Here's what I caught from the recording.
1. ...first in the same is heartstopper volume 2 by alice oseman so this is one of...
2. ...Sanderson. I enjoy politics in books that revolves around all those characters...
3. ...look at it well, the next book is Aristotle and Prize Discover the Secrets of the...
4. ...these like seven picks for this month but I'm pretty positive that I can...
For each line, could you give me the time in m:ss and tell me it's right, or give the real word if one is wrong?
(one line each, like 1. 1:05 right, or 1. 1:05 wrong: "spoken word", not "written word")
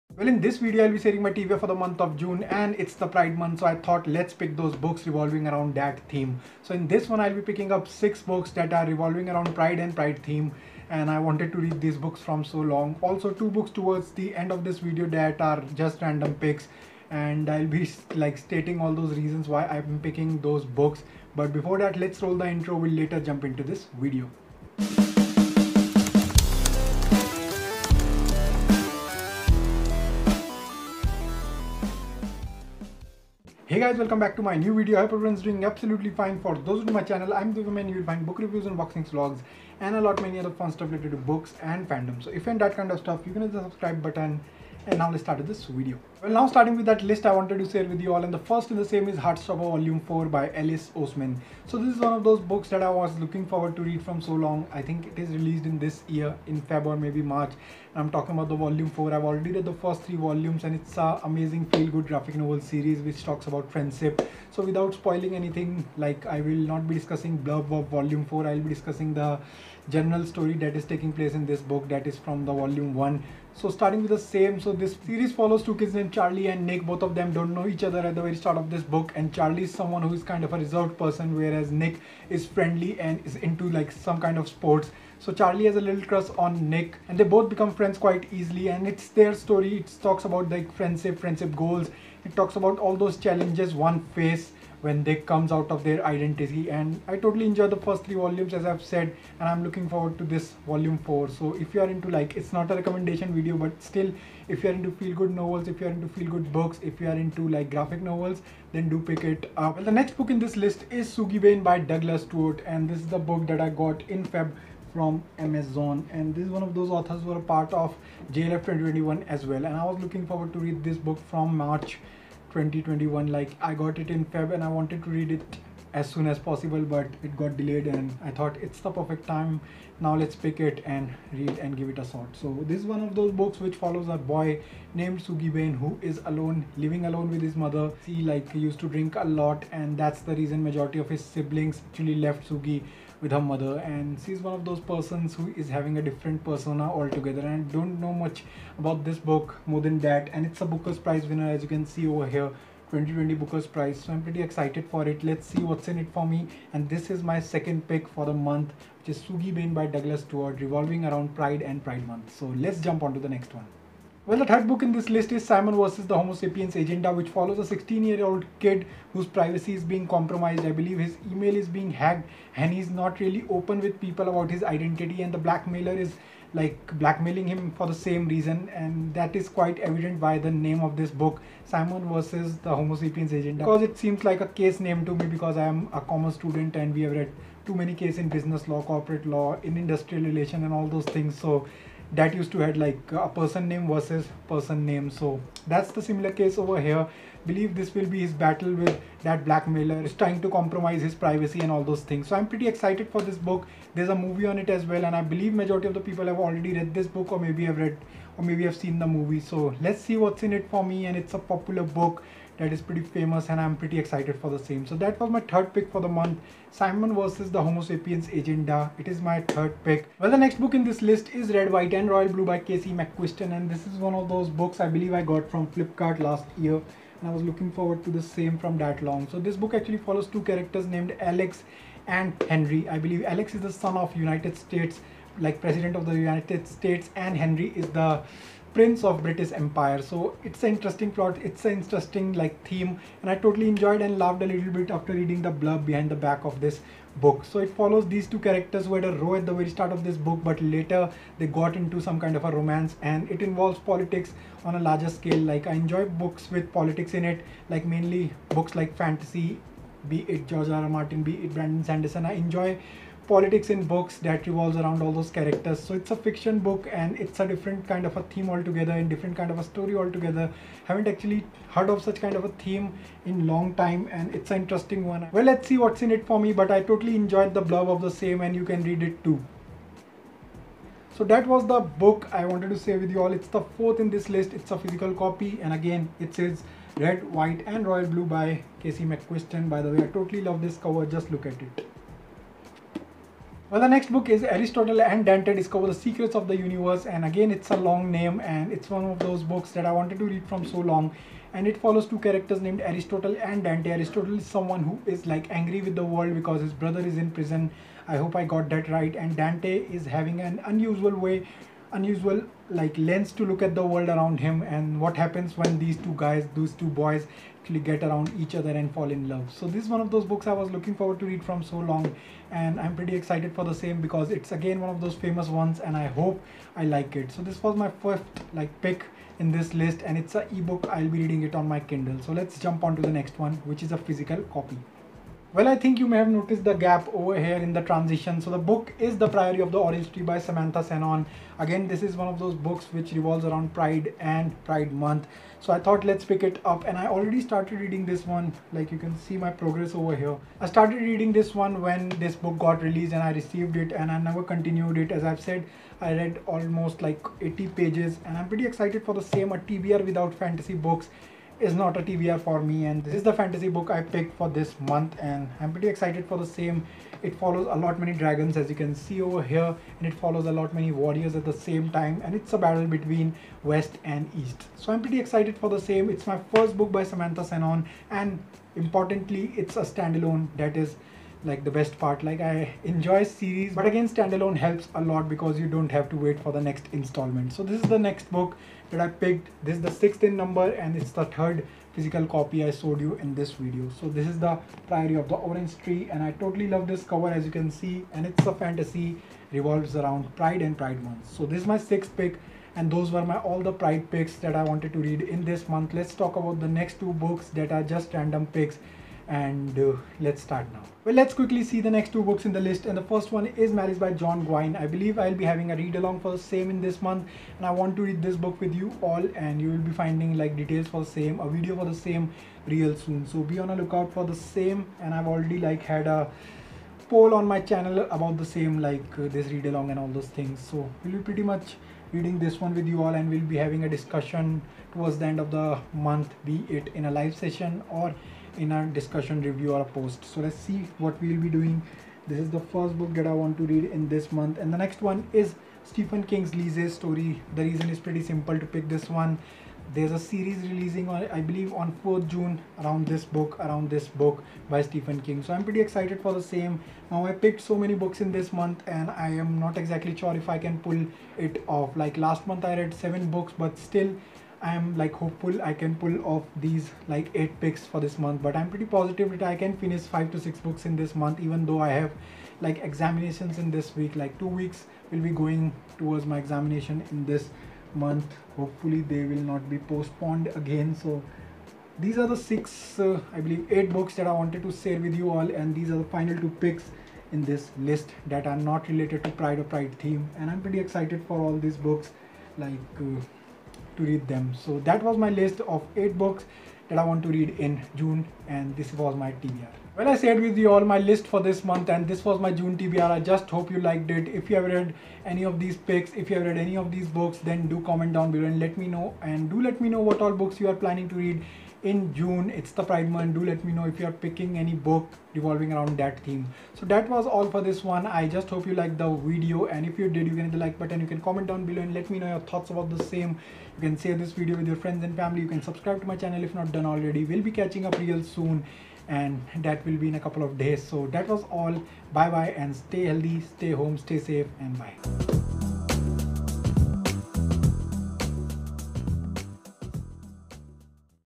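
1. 0:48 wrong: "4", not "2"
2. 4:21 right
3. 4:51 wrong: "Dante", not "Prize"
4. 7:46 wrong: "eight", not "seven".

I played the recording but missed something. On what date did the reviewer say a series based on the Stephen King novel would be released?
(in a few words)
4 June.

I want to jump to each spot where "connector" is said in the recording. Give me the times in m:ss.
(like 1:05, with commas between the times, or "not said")
not said.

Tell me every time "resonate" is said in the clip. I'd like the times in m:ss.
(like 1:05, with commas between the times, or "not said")
not said.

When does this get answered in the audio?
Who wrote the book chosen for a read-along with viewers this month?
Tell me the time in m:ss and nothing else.
6:54.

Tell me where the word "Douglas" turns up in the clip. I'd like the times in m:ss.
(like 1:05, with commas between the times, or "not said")
1:51, 2:39.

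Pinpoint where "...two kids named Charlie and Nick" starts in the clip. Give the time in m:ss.
1:15.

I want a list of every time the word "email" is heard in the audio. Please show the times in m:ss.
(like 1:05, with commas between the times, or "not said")
2:51.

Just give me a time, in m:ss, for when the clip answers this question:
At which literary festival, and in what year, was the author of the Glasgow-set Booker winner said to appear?
1:58.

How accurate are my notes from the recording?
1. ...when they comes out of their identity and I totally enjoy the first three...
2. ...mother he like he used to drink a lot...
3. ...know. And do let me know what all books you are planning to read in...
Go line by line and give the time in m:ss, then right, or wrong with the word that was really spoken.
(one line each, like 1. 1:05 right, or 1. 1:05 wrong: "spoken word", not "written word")
1. 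1:34 right
2. 2:17 right
3. 8:28 right.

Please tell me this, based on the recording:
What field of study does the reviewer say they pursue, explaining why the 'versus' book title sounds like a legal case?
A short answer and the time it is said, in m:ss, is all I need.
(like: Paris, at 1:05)
Commerce, at 3:06.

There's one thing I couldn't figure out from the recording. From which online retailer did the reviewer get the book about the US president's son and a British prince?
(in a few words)
Flipkart.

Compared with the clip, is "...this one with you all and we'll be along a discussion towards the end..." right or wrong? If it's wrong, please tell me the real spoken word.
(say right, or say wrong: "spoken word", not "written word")
wrong: "having", not "along".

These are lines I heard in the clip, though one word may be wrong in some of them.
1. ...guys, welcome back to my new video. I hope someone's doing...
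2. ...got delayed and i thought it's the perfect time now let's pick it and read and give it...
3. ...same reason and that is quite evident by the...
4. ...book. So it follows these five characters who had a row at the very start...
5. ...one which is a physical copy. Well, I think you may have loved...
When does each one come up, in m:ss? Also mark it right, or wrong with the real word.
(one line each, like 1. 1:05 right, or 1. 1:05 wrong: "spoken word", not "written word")
1. 0:33 wrong: "everyone", not "someone"
2. 2:07 right
3. 2:57 right
4. 4:07 wrong: "two", not "five"
5. 5:33 wrong: "noticed", not "loved".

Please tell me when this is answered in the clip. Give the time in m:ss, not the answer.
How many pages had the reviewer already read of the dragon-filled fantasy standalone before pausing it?
5:57.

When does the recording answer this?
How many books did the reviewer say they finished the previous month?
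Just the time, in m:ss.
7:42.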